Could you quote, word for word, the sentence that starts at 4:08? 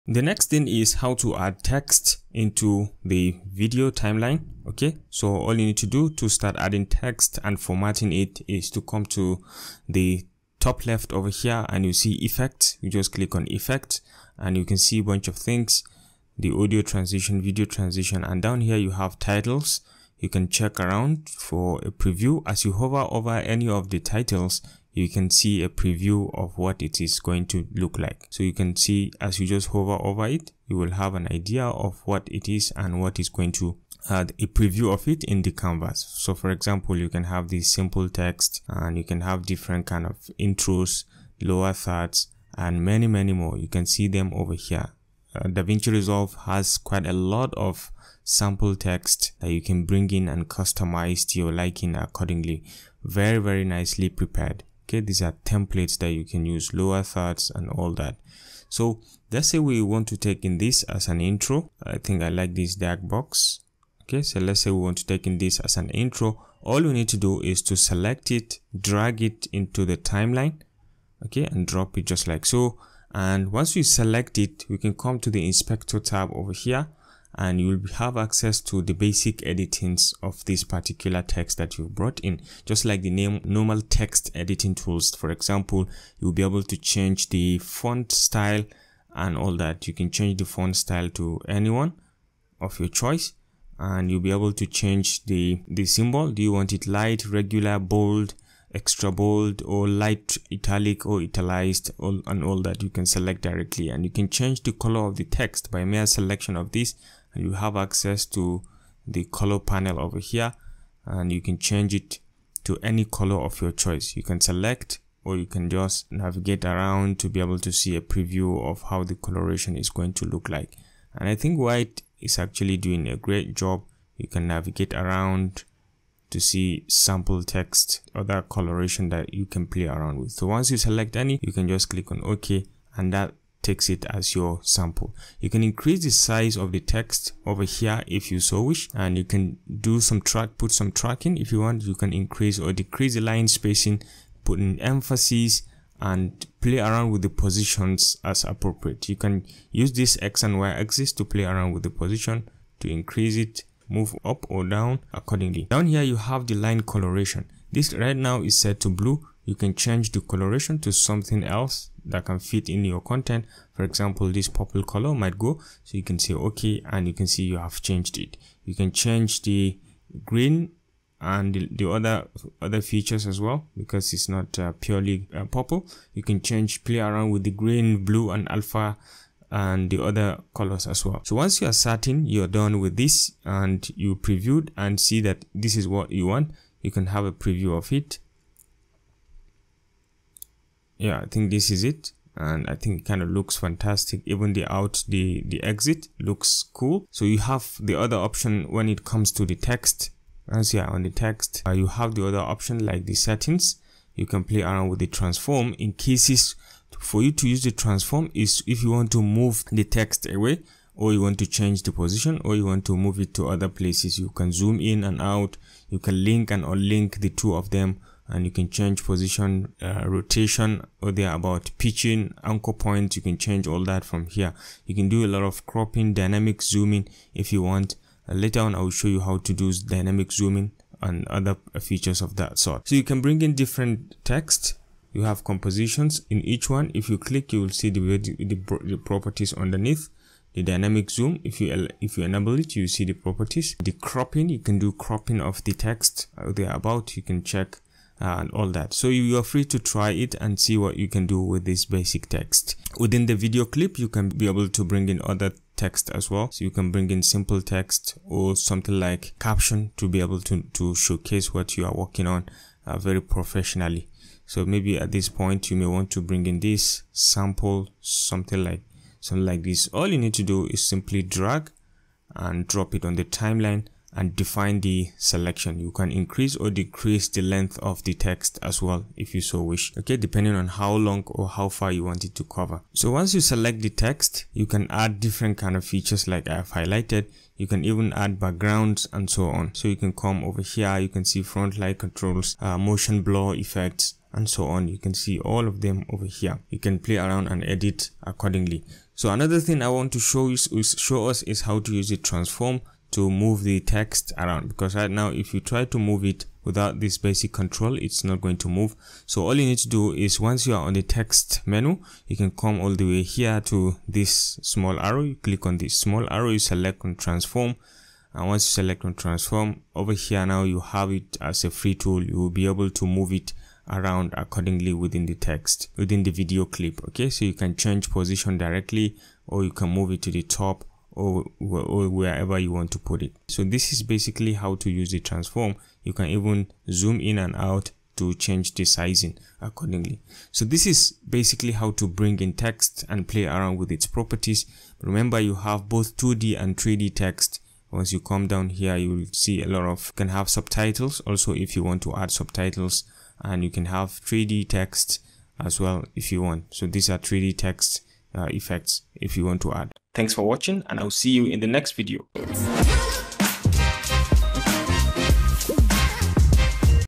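So you are free to try it and see what you can do with this basic text.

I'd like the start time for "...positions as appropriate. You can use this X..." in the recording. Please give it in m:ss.
2:27.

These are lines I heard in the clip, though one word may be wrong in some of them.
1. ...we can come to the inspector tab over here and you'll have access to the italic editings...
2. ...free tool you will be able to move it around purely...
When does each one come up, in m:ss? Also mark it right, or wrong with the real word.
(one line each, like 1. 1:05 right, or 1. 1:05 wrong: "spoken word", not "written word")
1. 1:14 wrong: "basic", not "italic"
2. 5:21 wrong: "accordingly", not "purely".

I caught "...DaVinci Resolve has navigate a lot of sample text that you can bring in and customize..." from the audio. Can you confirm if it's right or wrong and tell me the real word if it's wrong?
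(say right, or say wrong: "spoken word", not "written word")
wrong: "quite", not "navigate".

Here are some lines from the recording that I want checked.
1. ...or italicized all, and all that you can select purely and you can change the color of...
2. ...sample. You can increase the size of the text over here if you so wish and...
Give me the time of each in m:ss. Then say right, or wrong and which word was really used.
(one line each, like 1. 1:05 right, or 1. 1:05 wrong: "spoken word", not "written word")
1. 1:41 wrong: "directly", not "purely"
2. 2:14 right.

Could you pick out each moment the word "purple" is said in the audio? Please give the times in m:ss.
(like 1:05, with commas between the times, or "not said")
2:44, 2:55.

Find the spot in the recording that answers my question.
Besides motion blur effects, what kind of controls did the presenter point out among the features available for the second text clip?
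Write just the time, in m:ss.
4:51.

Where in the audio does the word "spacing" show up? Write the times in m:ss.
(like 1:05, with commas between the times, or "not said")
2:23.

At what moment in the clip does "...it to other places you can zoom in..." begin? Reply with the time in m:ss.
3:33.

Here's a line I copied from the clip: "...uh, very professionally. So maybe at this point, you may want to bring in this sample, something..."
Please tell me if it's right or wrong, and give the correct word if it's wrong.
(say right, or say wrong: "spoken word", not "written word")
right.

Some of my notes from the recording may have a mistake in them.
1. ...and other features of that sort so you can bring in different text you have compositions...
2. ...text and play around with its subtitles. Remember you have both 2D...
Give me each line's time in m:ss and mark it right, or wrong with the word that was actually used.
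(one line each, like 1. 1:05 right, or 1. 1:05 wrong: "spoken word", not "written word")
1. 3:51 right
2. 5:42 wrong: "properties", not "subtitles".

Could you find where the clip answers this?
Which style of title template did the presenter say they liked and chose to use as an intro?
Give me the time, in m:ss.
1:02.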